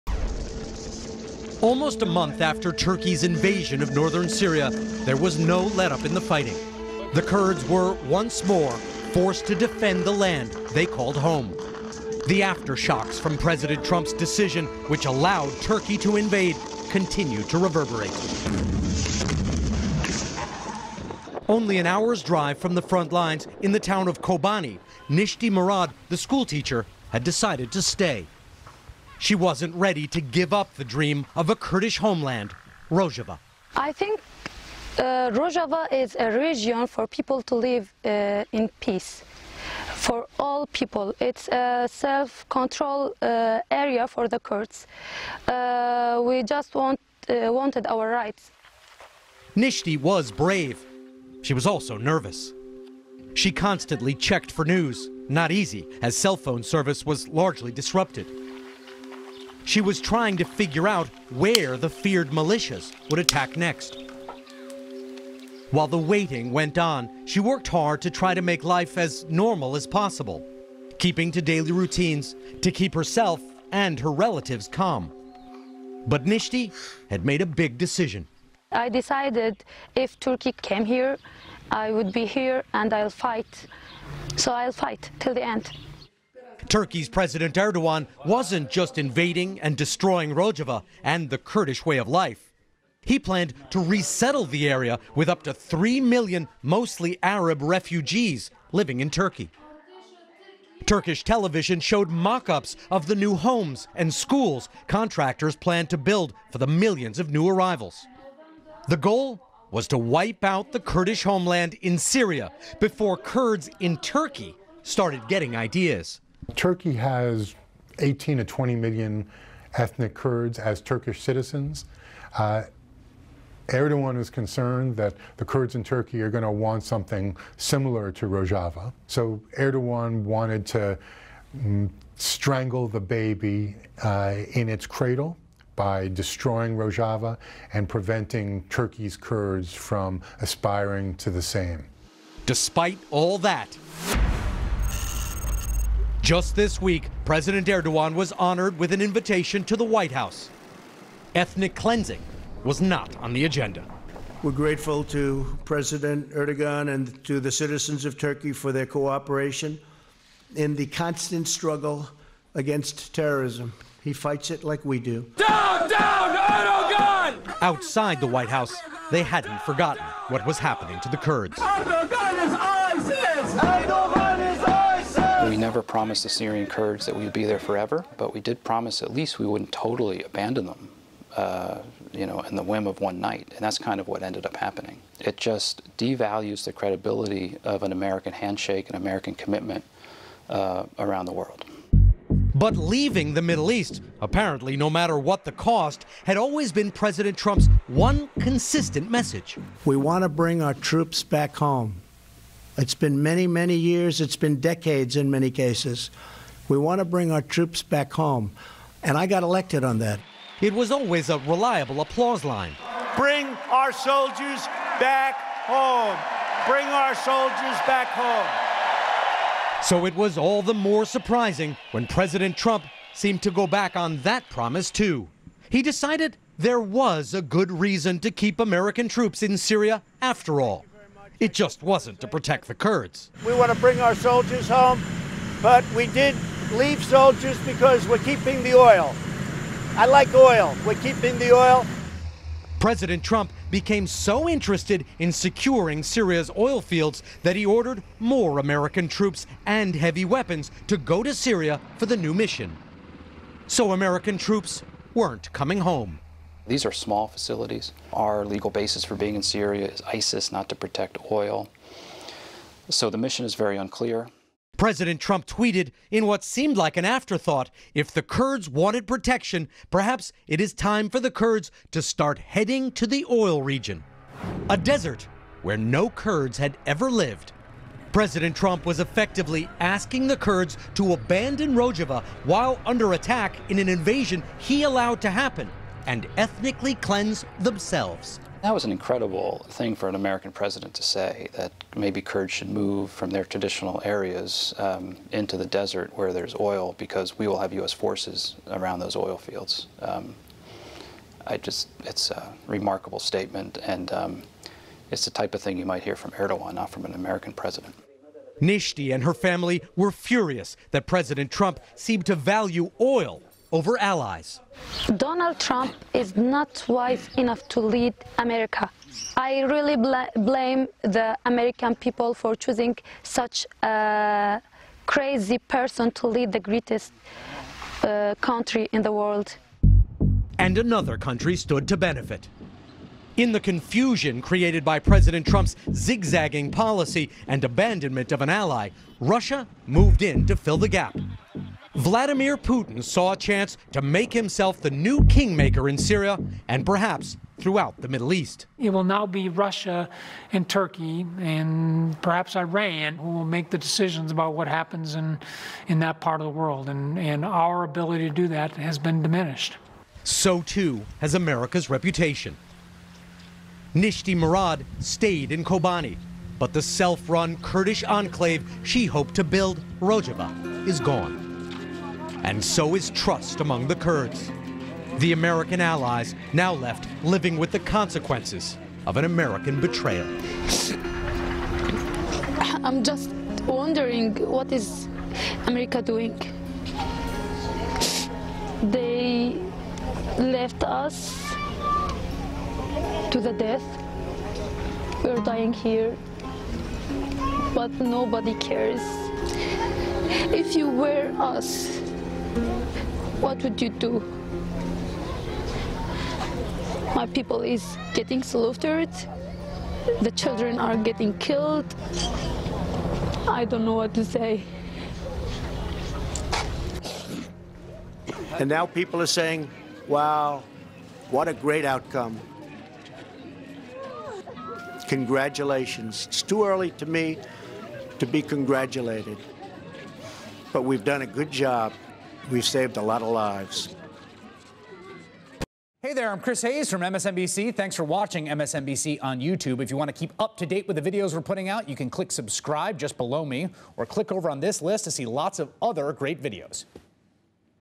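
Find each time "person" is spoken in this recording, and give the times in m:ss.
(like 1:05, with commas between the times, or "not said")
5:25.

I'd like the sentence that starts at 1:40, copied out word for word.
Turkish television showed mock ups of the new homes and schools contractors planned to build for the millions of new arrivals.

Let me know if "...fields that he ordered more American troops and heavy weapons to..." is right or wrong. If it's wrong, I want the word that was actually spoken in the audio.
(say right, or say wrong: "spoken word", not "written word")
right.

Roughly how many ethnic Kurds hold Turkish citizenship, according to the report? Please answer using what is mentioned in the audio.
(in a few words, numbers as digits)
18 to 20 million.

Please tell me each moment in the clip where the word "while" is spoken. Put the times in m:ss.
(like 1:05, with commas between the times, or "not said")
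1:05, 4:42.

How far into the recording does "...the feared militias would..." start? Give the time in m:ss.
1:01.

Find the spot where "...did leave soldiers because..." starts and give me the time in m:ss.
3:56.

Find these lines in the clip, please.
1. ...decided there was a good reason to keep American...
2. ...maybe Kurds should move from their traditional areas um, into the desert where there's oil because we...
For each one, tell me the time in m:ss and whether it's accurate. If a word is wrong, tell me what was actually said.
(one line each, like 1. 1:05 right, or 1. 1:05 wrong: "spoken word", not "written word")
1. 3:45 right
2. 4:51 right.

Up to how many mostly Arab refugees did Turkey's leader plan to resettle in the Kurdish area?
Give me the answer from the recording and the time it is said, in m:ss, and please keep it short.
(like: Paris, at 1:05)
3 million, at 1:35.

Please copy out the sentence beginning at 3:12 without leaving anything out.
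But leaving the Middle East, apparently no matter what the cost, had always been President Trump's one consistent message.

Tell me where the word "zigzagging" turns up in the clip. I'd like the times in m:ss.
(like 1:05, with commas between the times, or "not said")
5:35.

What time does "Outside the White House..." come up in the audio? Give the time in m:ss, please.
2:47.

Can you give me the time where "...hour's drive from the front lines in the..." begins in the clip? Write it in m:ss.
0:21.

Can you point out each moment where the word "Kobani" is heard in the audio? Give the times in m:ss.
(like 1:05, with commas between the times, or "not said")
0:24, 6:05.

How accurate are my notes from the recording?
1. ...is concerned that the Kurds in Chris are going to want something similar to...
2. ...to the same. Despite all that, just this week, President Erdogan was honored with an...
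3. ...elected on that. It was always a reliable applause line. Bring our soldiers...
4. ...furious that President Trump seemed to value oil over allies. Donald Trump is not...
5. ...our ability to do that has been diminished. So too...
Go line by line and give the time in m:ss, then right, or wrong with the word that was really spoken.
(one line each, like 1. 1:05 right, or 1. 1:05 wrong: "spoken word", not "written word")
1. 2:04 wrong: "Turkey", not "Chris"
2. 2:21 right
3. 3:29 right
4. 5:10 right
5. 5:57 right.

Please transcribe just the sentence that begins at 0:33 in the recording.
I think uh, Rojava is a region for people to live uh, in peace.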